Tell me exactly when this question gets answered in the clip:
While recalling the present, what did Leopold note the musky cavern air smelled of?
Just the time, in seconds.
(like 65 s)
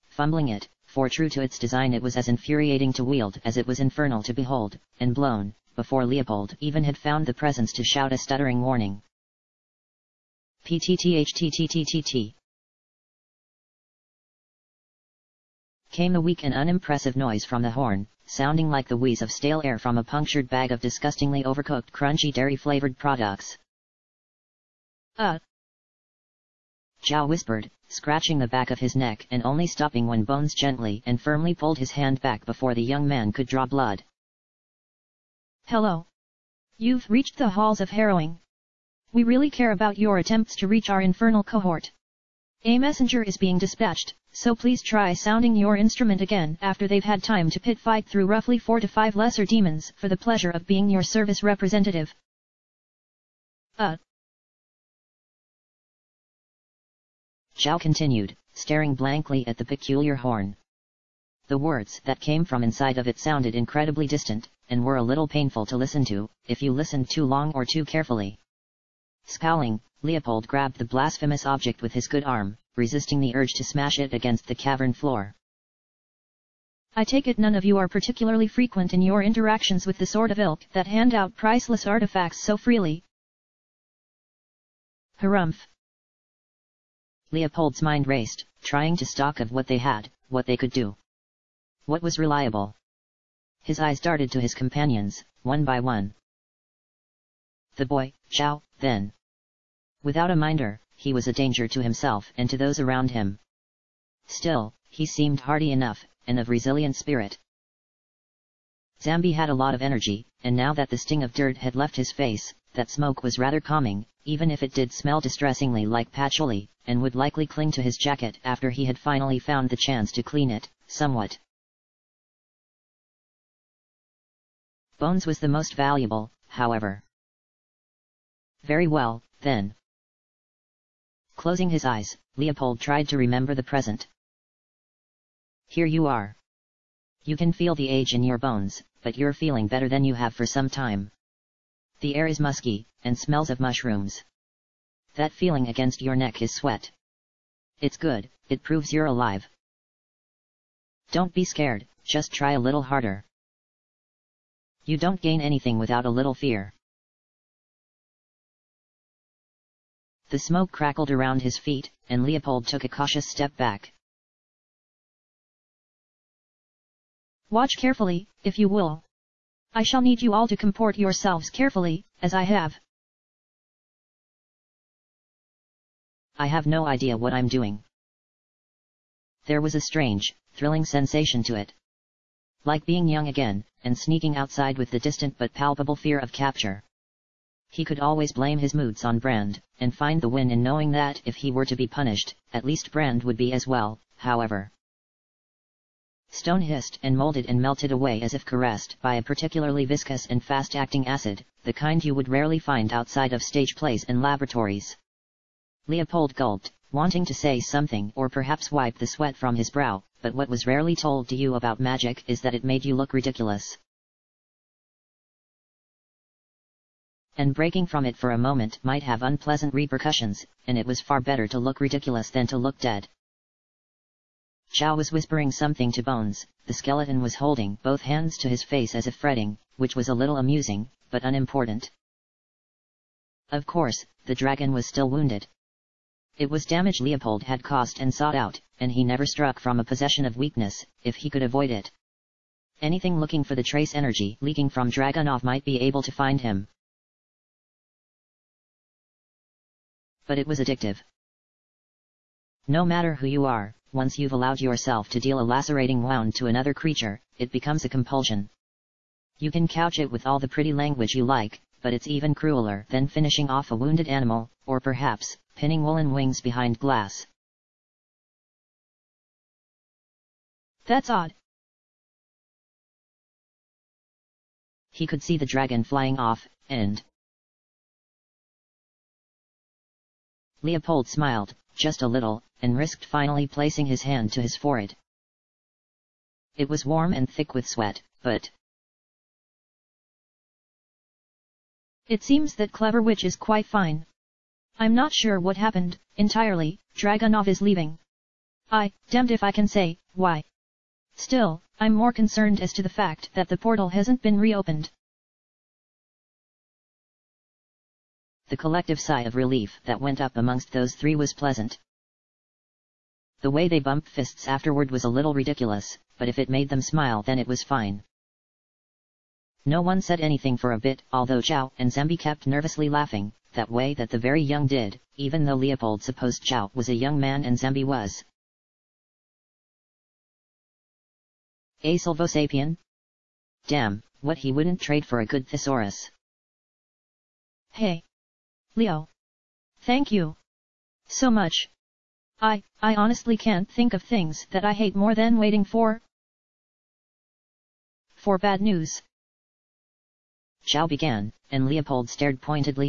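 143 s.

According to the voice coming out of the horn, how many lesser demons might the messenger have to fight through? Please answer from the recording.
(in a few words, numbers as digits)
4 to 5.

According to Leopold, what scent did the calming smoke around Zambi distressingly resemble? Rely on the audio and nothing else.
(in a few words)
patchouli.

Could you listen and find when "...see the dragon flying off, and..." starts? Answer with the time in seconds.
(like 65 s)
275 s.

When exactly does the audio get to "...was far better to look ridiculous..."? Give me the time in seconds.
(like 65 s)
220 s.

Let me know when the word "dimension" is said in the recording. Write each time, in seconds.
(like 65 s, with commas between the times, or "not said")
not said.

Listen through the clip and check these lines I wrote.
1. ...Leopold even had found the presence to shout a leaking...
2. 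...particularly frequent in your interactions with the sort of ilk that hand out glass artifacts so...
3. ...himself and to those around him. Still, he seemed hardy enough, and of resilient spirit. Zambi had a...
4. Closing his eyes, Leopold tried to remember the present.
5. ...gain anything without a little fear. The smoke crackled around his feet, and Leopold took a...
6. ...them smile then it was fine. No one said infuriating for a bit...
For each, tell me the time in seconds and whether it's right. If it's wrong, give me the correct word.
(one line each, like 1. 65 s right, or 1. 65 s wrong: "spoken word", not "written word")
1. 6 s wrong: "stuttering", not "leaking"
2. 77 s wrong: "priceless", not "glass"
3. 101 s right
4. 131 s right
5. 155 s right
6. 316 s wrong: "anything", not "infuriating".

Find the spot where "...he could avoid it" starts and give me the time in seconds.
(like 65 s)
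241 s.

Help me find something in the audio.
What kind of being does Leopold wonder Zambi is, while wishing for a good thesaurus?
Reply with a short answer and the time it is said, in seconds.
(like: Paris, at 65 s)
Silvosapien, at 331 s.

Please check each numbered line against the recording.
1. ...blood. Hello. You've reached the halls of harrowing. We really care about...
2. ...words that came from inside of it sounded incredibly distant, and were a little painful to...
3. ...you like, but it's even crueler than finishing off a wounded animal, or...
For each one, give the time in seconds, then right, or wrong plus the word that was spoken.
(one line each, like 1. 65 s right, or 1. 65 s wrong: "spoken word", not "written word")
1. 33 s right
2. 61 s right
3. 261 s right.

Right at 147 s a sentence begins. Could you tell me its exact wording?
It's good, it proves you're alive.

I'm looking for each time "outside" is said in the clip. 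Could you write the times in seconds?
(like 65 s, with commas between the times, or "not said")
184 s, 202 s.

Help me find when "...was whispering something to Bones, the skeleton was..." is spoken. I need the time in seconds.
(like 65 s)
224 s.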